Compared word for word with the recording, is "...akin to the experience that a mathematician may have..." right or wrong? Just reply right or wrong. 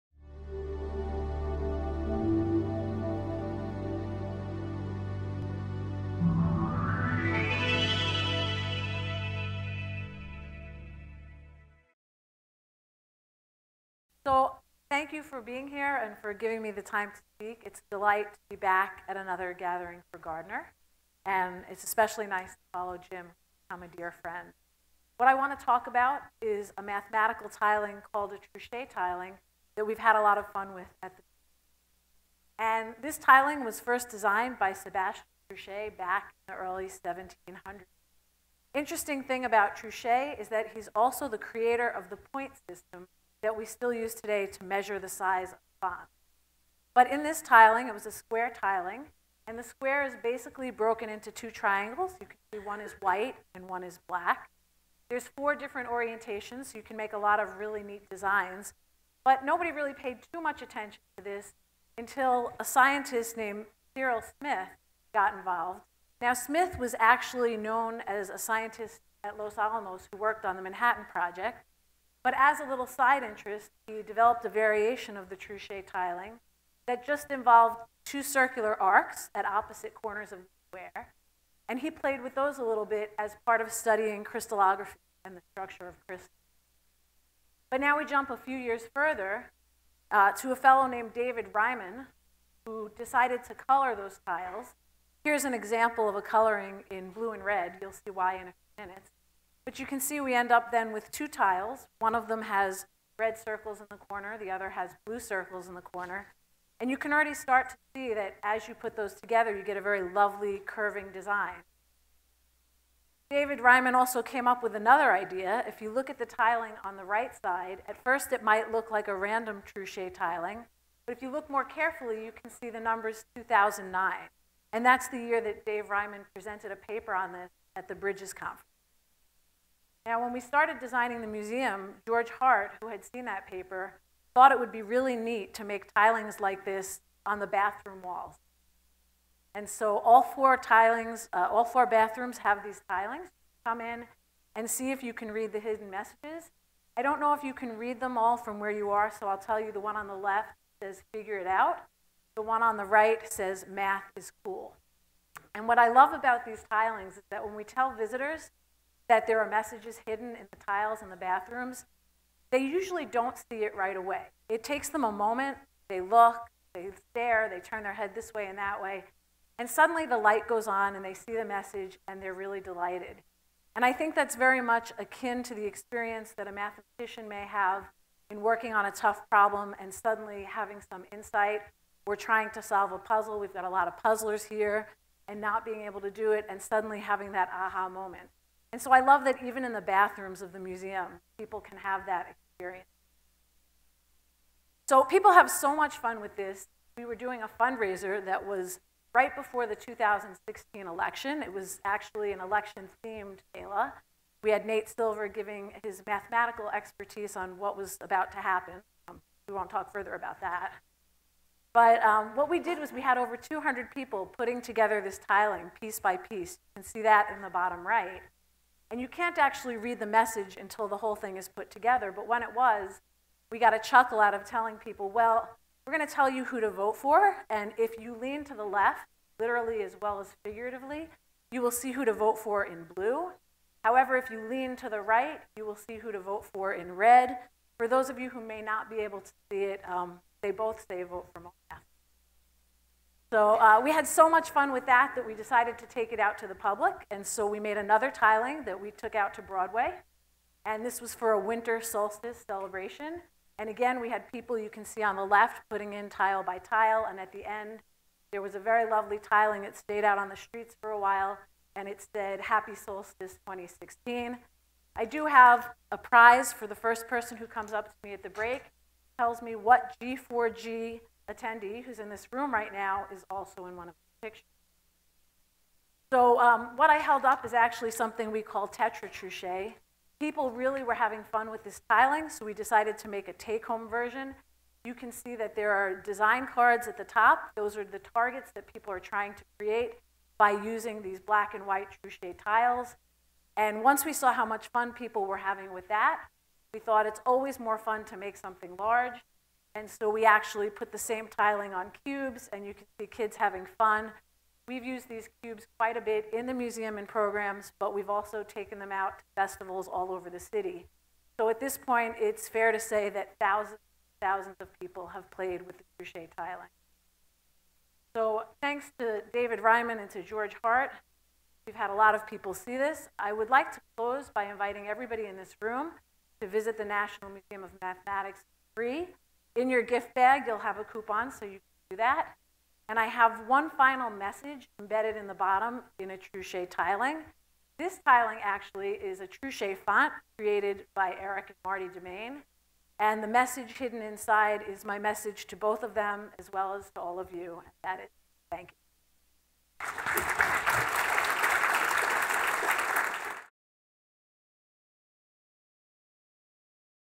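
right.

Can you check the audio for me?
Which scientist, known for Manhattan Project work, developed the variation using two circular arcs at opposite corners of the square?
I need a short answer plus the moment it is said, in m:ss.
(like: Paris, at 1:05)
Cyril Smith, at 1:03.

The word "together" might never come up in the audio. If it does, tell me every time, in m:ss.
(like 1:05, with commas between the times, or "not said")
1:49, 3:34, 3:41.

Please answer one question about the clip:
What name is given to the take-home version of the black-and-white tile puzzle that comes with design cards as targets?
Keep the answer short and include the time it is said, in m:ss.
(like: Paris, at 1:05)
tetra truchet, at 4:38.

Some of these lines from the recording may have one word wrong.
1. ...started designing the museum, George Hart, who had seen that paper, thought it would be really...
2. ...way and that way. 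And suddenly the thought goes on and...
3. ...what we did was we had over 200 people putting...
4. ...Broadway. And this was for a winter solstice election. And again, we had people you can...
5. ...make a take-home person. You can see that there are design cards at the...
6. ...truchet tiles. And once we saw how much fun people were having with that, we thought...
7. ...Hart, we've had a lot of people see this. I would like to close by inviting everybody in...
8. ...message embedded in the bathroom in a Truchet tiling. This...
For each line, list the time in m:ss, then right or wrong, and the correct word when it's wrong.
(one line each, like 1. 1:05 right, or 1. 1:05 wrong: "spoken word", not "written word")
1. 2:10 right
2. 2:48 wrong: "light", not "thought"
3. 3:32 right
4. 4:09 wrong: "celebration", not "election"
5. 4:43 wrong: "version", not "person"
6. 4:52 right
7. 5:20 right
8. 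5:34 wrong: "bottom", not "bathroom".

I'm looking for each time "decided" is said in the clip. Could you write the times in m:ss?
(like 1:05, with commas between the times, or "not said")
1:32, 4:05, 4:42.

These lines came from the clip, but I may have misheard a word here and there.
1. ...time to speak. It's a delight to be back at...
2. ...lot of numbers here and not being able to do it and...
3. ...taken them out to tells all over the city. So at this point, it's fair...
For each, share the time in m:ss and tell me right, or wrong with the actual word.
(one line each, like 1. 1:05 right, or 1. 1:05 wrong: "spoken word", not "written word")
1. 0:16 right
2. 3:03 wrong: "puzzlers", not "numbers"
3. 5:08 wrong: "festivals", not "tells".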